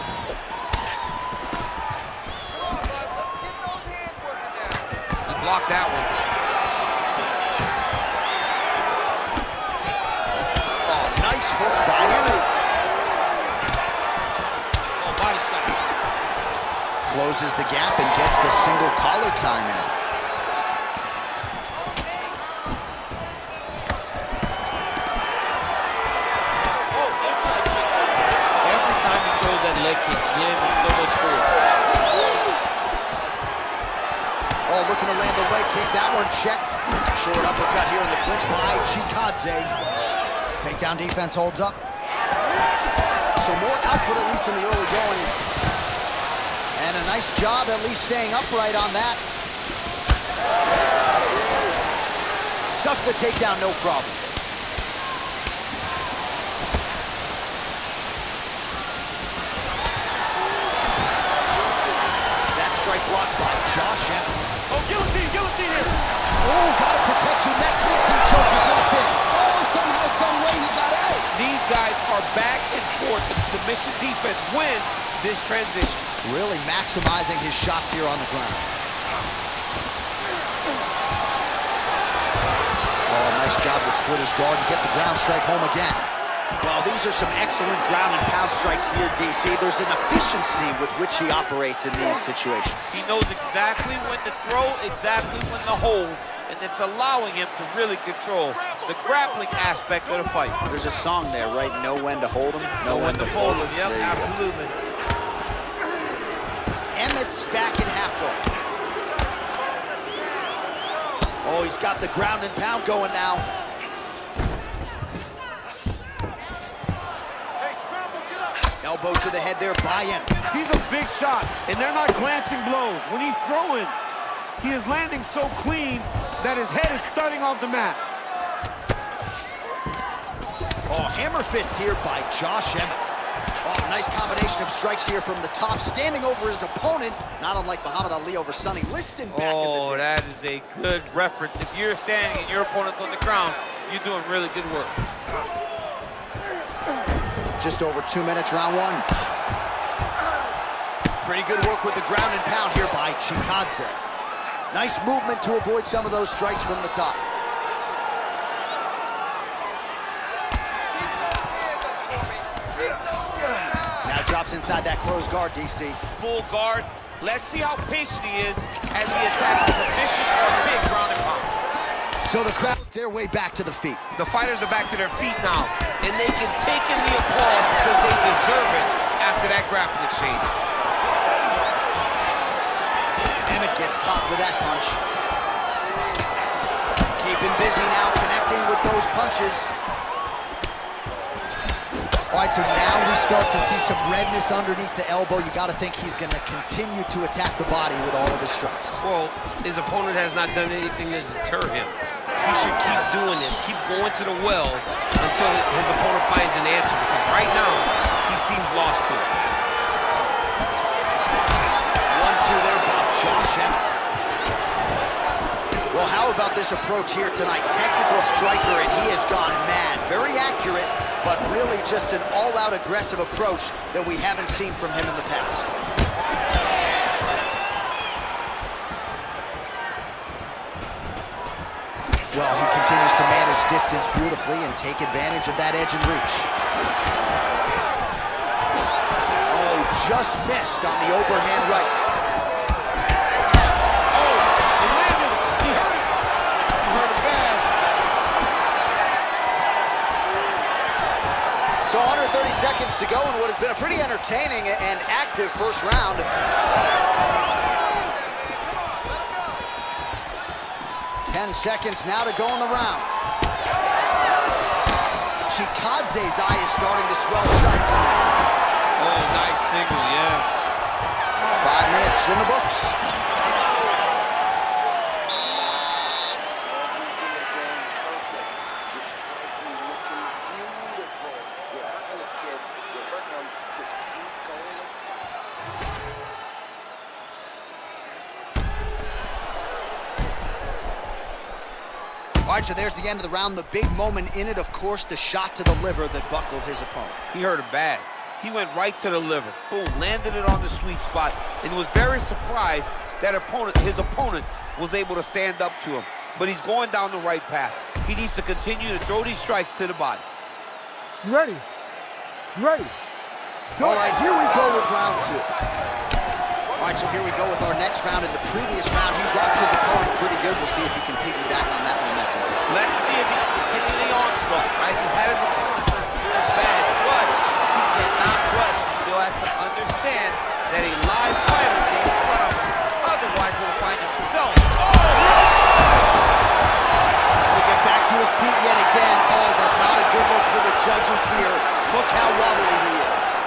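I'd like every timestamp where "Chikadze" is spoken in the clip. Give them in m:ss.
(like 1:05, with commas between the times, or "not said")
0:38, 2:33, 4:25.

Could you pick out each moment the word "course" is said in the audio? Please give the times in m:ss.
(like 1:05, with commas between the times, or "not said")
4:54.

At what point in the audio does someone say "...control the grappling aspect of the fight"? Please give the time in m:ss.
1:38.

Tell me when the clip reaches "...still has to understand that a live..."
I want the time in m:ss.
5:28.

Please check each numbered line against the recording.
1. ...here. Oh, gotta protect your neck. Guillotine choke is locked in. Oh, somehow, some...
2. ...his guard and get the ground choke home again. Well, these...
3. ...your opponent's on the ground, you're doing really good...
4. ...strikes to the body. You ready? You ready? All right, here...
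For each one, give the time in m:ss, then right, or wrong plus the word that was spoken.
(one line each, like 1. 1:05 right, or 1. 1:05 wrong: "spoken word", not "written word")
1. 1:05 right
2. 1:24 wrong: "strike", not "choke"
3. 2:22 right
4. 5:09 right.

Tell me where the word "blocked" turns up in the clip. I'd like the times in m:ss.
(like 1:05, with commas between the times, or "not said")
0:05, 1:03.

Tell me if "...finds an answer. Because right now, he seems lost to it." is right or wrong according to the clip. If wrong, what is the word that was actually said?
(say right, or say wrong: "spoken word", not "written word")
right.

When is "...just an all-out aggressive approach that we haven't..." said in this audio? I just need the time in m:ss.
3:41.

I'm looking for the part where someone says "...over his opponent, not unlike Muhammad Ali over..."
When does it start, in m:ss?
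2:16.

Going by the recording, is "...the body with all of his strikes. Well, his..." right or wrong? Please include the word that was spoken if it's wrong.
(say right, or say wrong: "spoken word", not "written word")
right.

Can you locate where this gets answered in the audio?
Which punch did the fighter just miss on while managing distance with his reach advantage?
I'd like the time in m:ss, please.
4:01.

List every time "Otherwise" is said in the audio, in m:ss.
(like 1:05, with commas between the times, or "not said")
5:33.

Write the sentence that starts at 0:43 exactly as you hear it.
So more output, at least in the early going.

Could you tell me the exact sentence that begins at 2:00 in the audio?
He's a big shot, and they're not glancing blows.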